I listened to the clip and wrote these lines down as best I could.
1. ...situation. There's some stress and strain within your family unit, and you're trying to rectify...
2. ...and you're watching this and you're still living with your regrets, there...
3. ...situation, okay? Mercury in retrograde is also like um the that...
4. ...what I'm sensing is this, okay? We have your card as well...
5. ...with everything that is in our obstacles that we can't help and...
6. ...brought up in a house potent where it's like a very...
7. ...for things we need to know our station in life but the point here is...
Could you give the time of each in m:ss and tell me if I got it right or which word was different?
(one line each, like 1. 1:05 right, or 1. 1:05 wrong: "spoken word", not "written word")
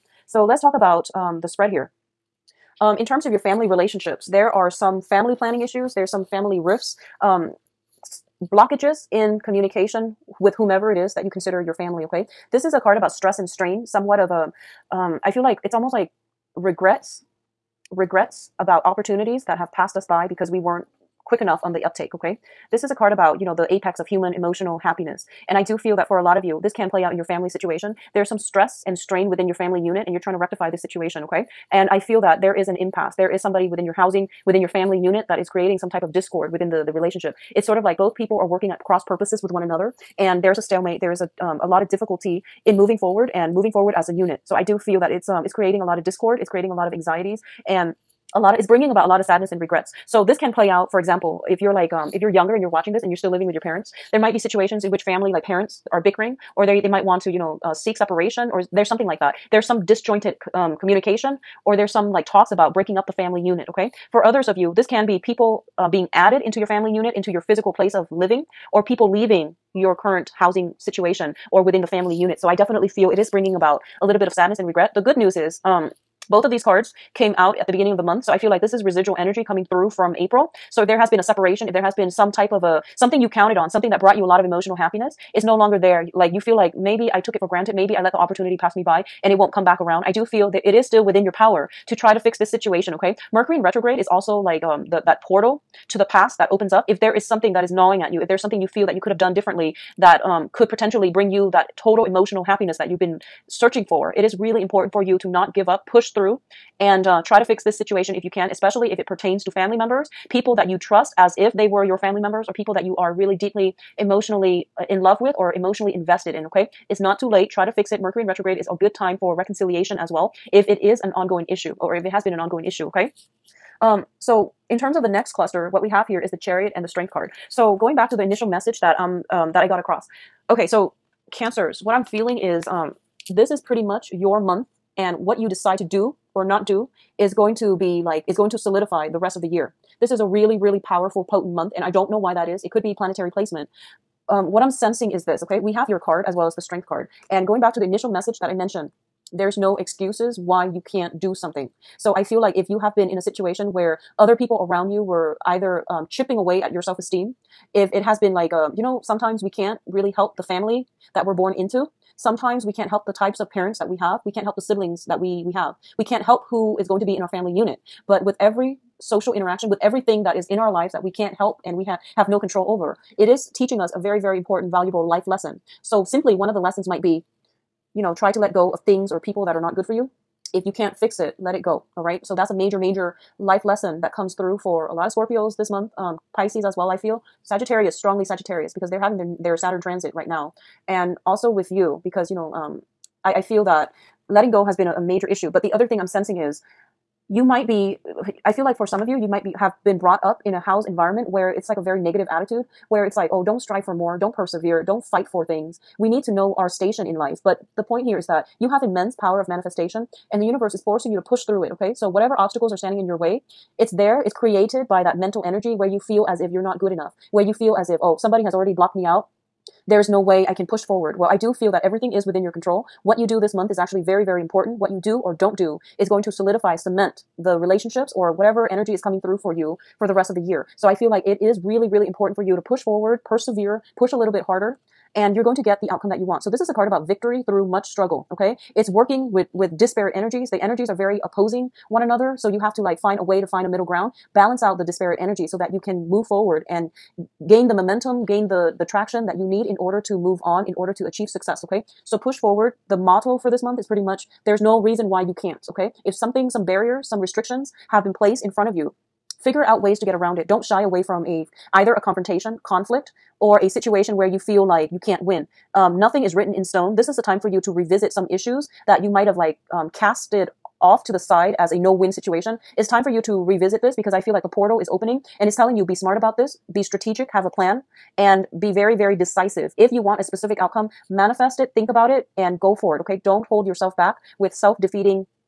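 1. 0:27 right
2. 0:52 wrong: "parents", not "regrets"
3. 1:32 right
4. 2:24 right
5. 2:49 wrong: "lives", not "obstacles"
6. 3:19 wrong: "environment", not "potent"
7. 3:25 right.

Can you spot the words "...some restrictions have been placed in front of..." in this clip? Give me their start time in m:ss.
4:17.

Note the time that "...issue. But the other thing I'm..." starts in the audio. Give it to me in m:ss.
3:15.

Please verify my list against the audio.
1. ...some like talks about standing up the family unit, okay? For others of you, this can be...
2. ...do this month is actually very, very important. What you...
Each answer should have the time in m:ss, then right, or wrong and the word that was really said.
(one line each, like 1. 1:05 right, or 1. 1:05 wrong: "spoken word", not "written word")
1. 1:01 wrong: "breaking", not "standing"
2. 3:43 right.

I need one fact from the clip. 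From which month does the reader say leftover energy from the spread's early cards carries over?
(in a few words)
April.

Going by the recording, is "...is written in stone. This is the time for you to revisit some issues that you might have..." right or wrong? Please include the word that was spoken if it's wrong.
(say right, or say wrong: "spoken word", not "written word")
right.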